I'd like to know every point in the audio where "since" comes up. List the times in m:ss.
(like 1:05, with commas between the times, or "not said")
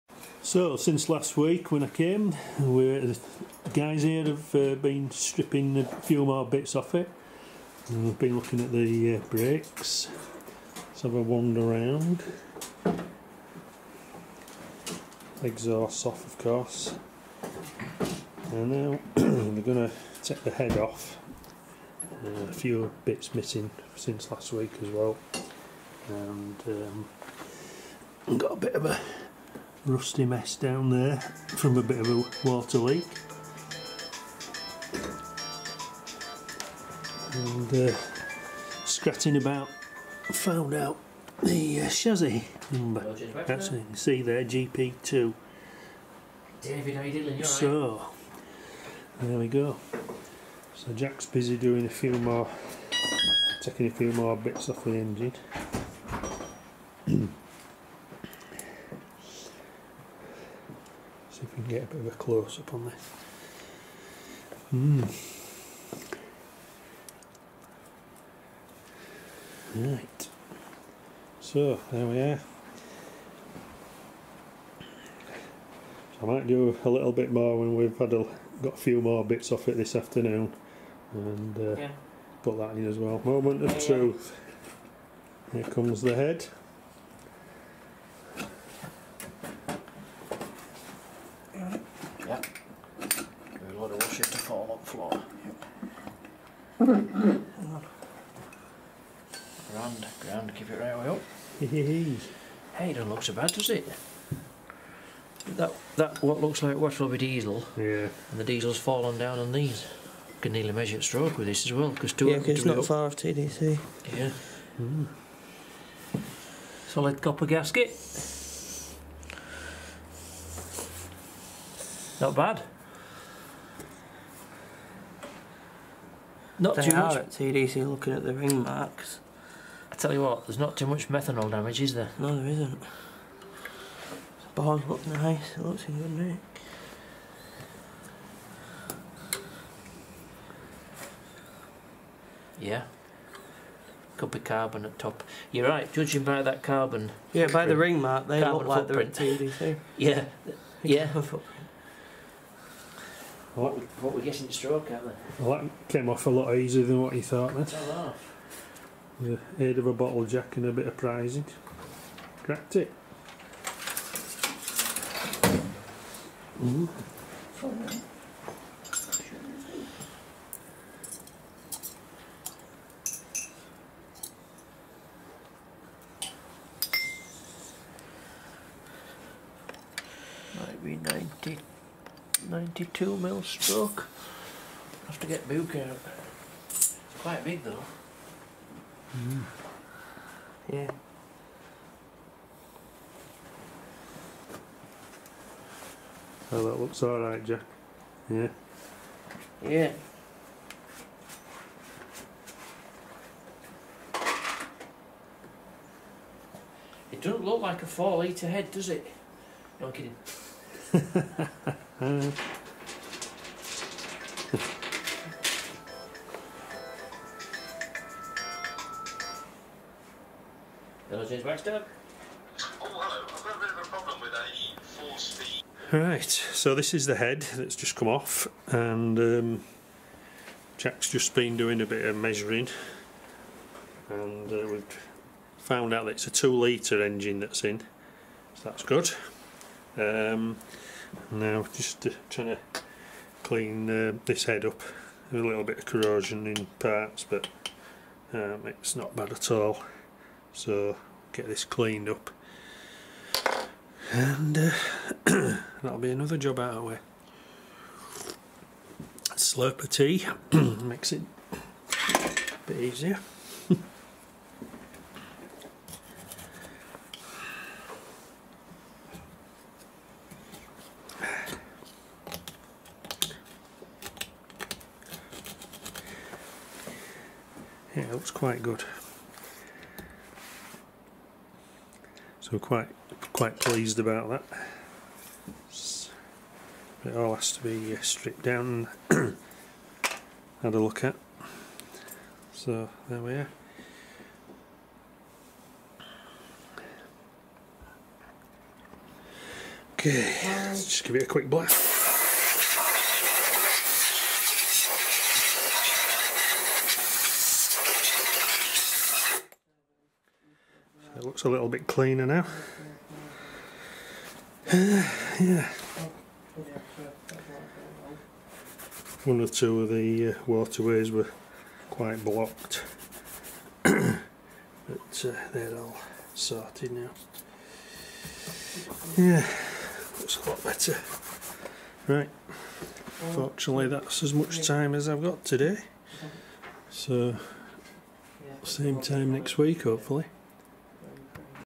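0:00, 0:23.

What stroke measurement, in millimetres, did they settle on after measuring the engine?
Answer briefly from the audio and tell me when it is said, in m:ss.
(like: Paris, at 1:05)
92 mm, at 3:02.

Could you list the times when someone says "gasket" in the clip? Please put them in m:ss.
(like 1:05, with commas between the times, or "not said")
1:57.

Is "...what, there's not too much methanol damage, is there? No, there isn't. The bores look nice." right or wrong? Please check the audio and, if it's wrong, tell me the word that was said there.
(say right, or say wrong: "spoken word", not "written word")
right.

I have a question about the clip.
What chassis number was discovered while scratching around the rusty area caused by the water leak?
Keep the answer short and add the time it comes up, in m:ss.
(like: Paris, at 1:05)
GP2, at 0:44.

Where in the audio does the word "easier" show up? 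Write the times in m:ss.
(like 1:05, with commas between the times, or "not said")
2:36, 4:22.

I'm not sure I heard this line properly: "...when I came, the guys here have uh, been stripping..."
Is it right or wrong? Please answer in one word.
right.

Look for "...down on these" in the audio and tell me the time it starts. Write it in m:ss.
1:49.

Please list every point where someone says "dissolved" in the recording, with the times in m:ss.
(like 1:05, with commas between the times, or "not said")
not said.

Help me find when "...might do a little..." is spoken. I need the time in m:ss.
1:16.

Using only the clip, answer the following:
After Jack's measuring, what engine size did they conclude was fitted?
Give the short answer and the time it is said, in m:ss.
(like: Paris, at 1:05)
2 litre, at 3:56.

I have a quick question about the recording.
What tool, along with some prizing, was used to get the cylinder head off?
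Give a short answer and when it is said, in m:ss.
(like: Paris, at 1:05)
Bottle jack, at 2:39.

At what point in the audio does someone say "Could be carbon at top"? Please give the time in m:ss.
2:24.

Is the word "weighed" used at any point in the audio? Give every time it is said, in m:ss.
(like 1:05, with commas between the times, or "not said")
not said.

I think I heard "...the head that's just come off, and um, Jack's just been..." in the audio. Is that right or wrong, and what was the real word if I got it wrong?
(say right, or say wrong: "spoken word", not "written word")
right.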